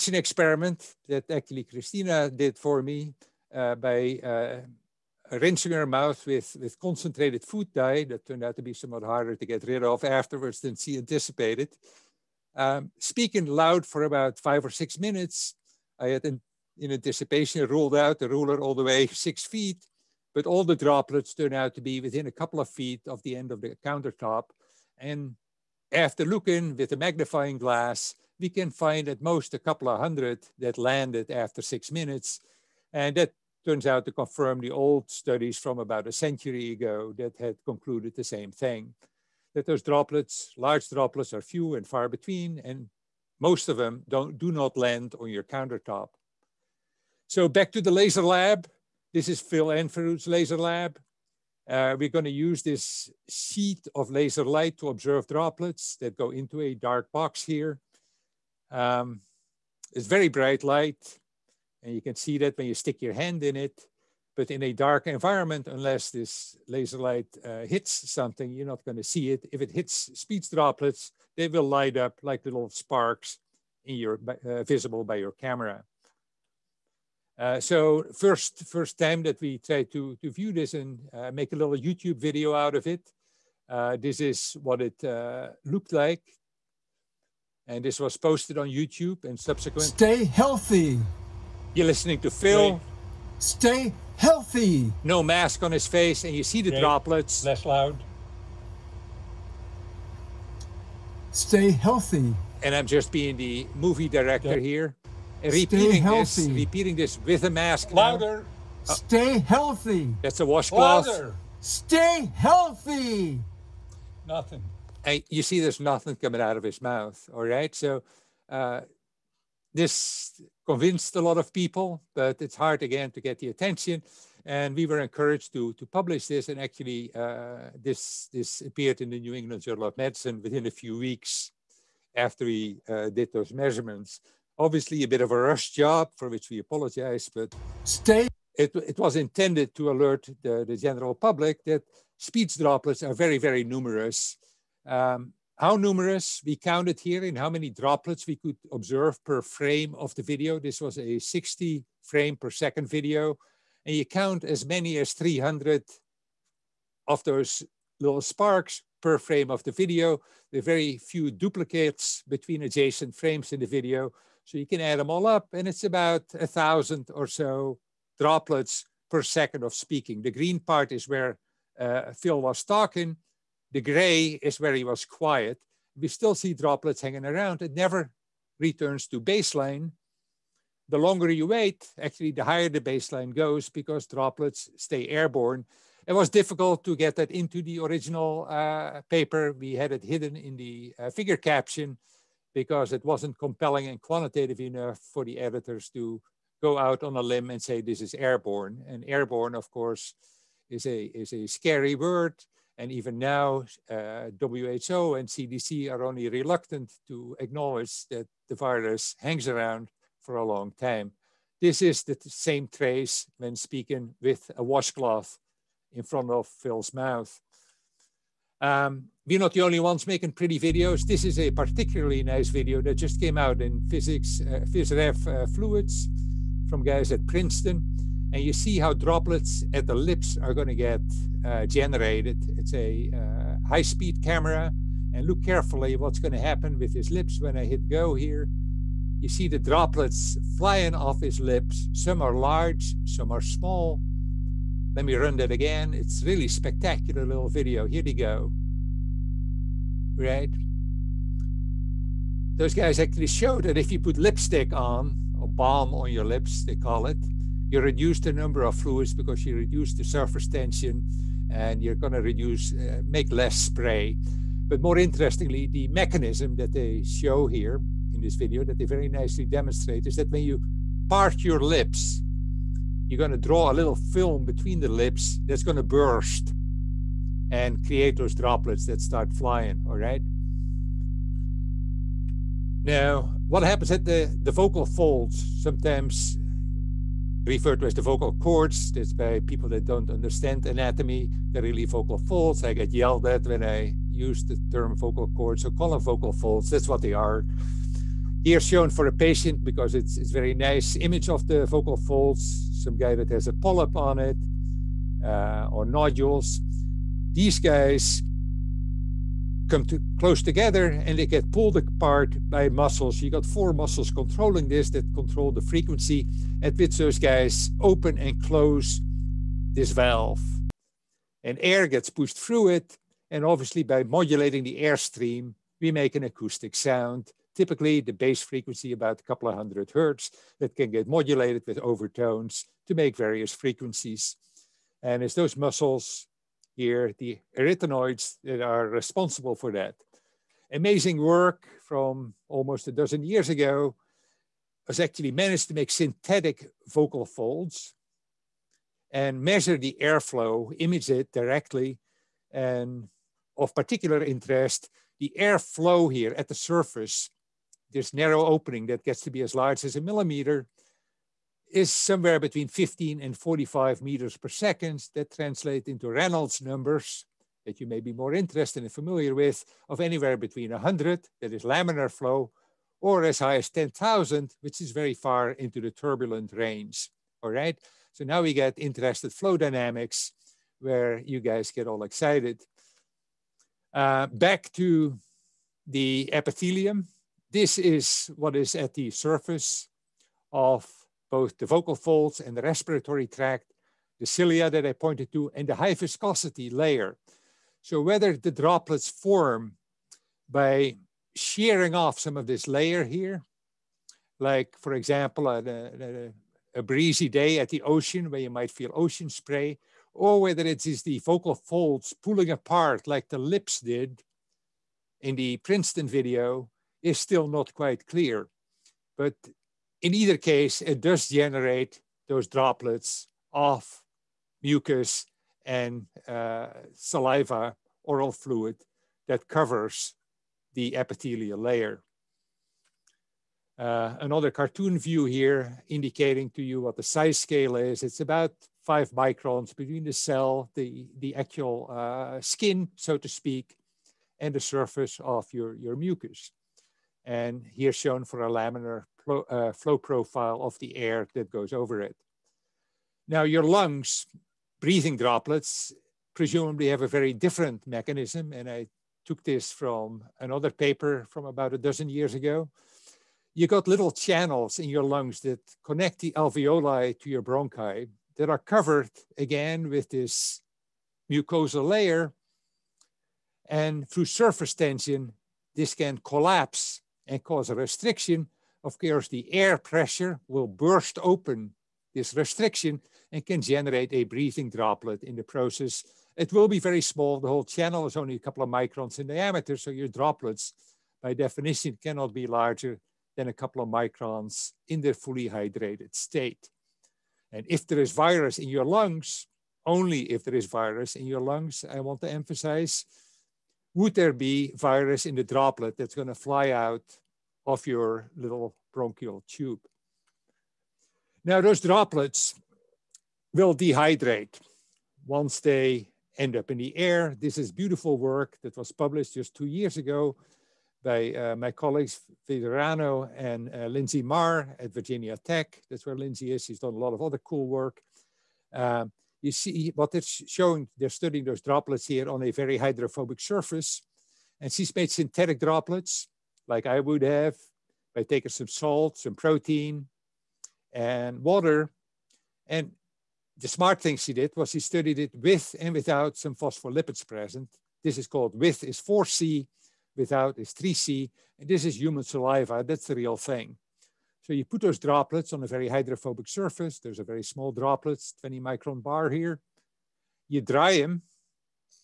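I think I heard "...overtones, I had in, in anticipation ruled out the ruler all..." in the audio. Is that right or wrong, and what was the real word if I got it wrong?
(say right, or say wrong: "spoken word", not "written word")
wrong: "minutes", not "overtones".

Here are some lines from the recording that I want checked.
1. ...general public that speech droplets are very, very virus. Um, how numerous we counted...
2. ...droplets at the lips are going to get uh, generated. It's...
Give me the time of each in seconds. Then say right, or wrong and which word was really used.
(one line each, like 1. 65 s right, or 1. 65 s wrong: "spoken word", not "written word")
1. 140 s wrong: "numerous", not "virus"
2. 228 s right.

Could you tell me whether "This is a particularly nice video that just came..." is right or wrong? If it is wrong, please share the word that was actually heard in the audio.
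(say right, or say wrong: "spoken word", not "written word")
right.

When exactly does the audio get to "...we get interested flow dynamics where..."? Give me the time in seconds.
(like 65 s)
378 s.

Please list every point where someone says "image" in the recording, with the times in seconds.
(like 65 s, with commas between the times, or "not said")
300 s, 350 s.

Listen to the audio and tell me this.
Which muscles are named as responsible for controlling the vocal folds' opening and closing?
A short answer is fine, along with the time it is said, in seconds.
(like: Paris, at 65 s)
arytenoids, at 337 s.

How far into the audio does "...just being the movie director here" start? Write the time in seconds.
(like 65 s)
102 s.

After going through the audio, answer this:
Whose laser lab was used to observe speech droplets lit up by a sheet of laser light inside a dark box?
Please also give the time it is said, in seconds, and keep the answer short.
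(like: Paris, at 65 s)
Phil Anfinrud, at 49 s.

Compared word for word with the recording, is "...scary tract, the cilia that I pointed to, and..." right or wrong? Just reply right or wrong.
wrong.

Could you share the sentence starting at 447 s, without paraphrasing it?
And here shown for a laminar pro, uh, flow profile of the air that goes over it.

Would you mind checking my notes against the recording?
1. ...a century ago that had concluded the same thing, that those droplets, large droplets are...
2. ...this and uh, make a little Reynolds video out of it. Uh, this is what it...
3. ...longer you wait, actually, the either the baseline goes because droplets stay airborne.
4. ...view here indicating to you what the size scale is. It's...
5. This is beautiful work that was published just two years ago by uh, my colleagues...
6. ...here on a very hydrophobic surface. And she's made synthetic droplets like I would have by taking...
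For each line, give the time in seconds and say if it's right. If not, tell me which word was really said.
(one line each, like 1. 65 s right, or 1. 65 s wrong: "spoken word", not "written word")
1. 36 s right
2. 80 s wrong: "YouTube", not "Reynolds"
3. 180 s wrong: "higher", not "either"
4. 434 s right
5. 517 s right
6. 532 s right.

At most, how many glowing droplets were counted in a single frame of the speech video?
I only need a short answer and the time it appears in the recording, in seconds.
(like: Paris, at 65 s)
300, at 155 s.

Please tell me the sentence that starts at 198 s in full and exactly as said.
And airborne, of course, is a, is a scary word.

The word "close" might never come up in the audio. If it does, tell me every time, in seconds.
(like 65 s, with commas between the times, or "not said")
310 s, 318 s.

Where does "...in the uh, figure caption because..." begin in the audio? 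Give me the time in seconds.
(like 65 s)
190 s.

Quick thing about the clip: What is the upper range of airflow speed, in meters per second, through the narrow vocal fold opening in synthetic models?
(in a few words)
45.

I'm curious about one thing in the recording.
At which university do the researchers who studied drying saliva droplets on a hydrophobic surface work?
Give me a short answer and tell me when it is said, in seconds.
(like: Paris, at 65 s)
Virginia Tech, at 524 s.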